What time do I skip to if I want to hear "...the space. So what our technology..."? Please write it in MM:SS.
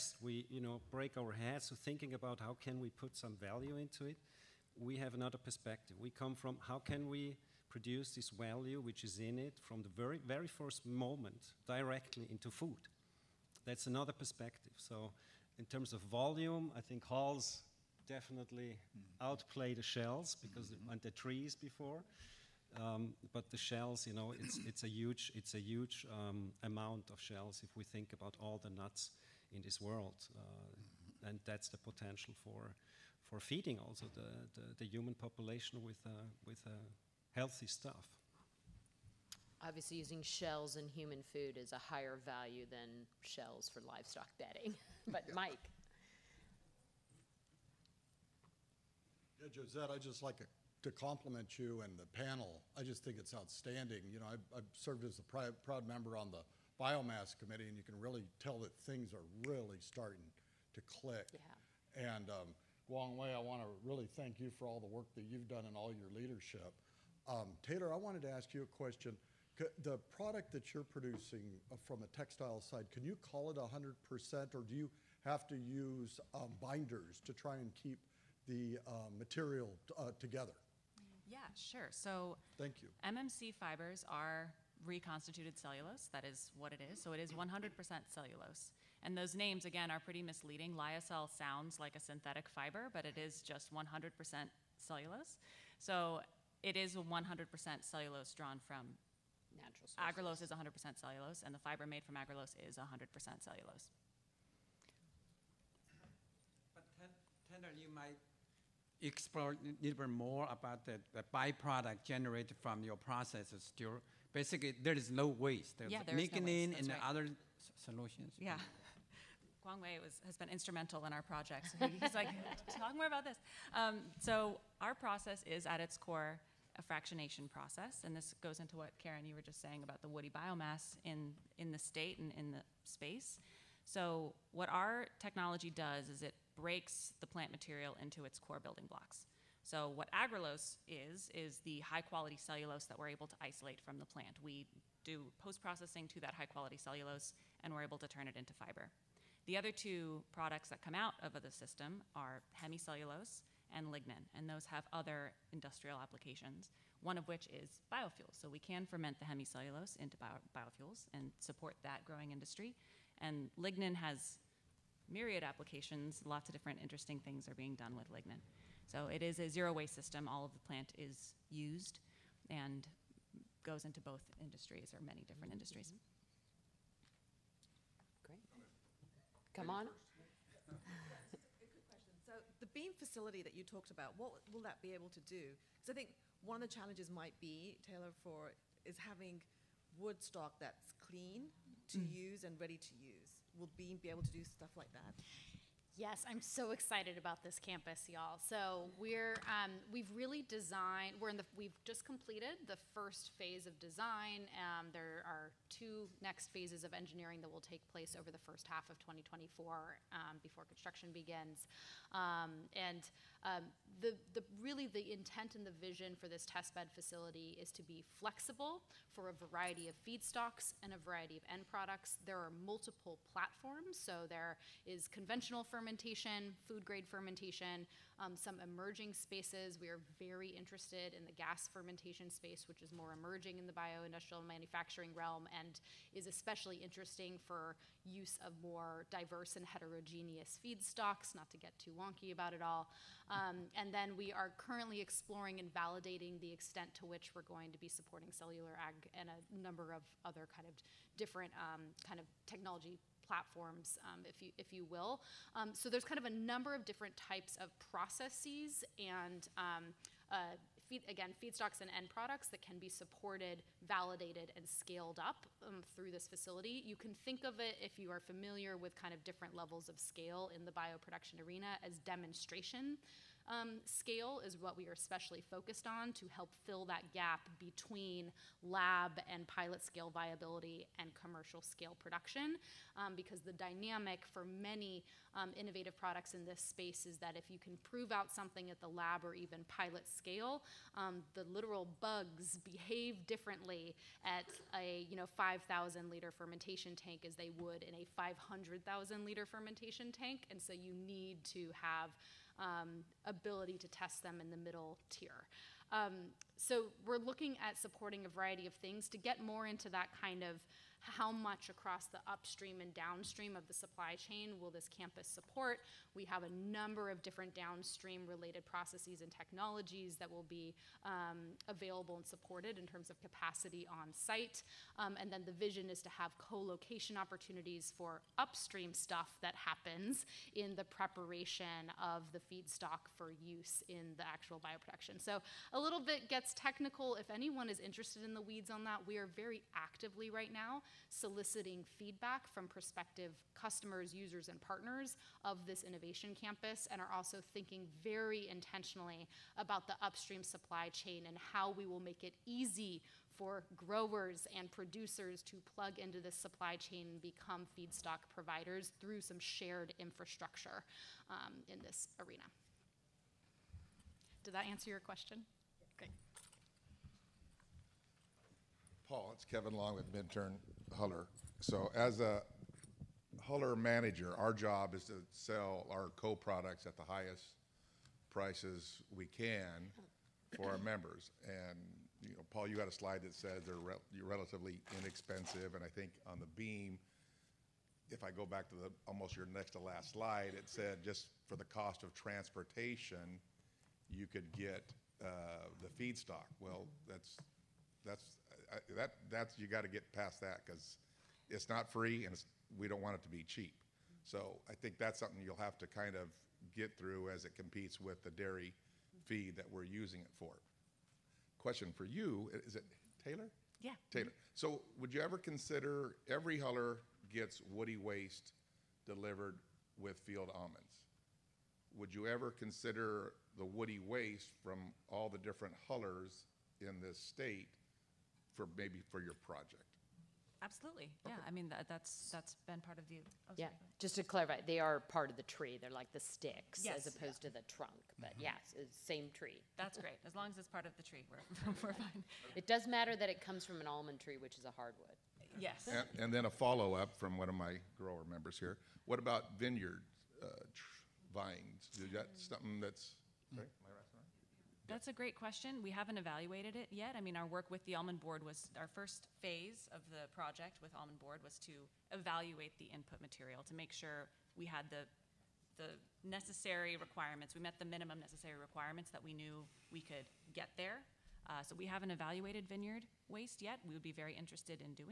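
02:12.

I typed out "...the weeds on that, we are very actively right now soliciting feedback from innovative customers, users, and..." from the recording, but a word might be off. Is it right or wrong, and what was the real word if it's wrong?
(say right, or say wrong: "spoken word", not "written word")
wrong: "prospective", not "innovative".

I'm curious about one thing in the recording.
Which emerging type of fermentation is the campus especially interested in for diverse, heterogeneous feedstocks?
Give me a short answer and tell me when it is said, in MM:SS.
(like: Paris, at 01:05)
gas fermentation, at 03:51.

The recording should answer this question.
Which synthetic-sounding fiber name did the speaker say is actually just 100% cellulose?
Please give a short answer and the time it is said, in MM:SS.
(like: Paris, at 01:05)
Lyocell, at 01:30.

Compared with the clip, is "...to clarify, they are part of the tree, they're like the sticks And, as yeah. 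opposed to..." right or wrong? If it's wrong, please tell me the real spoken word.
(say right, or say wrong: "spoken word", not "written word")
wrong: "Yes", not "And".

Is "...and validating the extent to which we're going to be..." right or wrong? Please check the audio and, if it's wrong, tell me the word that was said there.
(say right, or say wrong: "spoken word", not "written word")
right.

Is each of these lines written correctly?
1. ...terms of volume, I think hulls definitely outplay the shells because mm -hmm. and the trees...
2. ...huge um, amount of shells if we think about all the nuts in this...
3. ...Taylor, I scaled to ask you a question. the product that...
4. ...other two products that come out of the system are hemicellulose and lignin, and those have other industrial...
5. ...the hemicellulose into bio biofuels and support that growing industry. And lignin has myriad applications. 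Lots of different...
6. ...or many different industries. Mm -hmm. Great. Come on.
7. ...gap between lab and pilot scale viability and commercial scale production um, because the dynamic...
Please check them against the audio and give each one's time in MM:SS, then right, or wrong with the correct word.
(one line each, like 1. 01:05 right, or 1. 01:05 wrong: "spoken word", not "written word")
1. 00:15 right
2. 00:25 right
3. 01:07 wrong: "wanted", not "scaled"
4. 02:29 right
5. 02:39 right
6. 02:54 right
7. 04:37 right.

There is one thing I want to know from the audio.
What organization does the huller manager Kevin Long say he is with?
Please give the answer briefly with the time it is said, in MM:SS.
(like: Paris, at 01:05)
Minturn, at 06:10.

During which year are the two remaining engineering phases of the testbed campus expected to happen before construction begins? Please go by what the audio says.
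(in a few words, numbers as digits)
2024.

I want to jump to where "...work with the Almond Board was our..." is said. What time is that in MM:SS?
07:37.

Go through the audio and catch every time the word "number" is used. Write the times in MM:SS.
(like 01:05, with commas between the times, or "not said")
04:09, 04:16, 05:16.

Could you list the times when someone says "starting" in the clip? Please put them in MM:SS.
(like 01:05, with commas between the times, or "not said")
00:59.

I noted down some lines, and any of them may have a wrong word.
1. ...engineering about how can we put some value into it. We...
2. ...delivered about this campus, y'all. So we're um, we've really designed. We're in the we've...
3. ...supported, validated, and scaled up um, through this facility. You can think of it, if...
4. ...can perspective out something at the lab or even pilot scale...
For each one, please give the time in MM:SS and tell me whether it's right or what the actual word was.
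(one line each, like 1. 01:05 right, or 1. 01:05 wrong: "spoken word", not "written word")
1. 00:01 wrong: "thinking", not "engineering"
2. 03:16 wrong: "excited", not "delivered"
3. 04:22 right
4. 04:47 wrong: "prove", not "perspective".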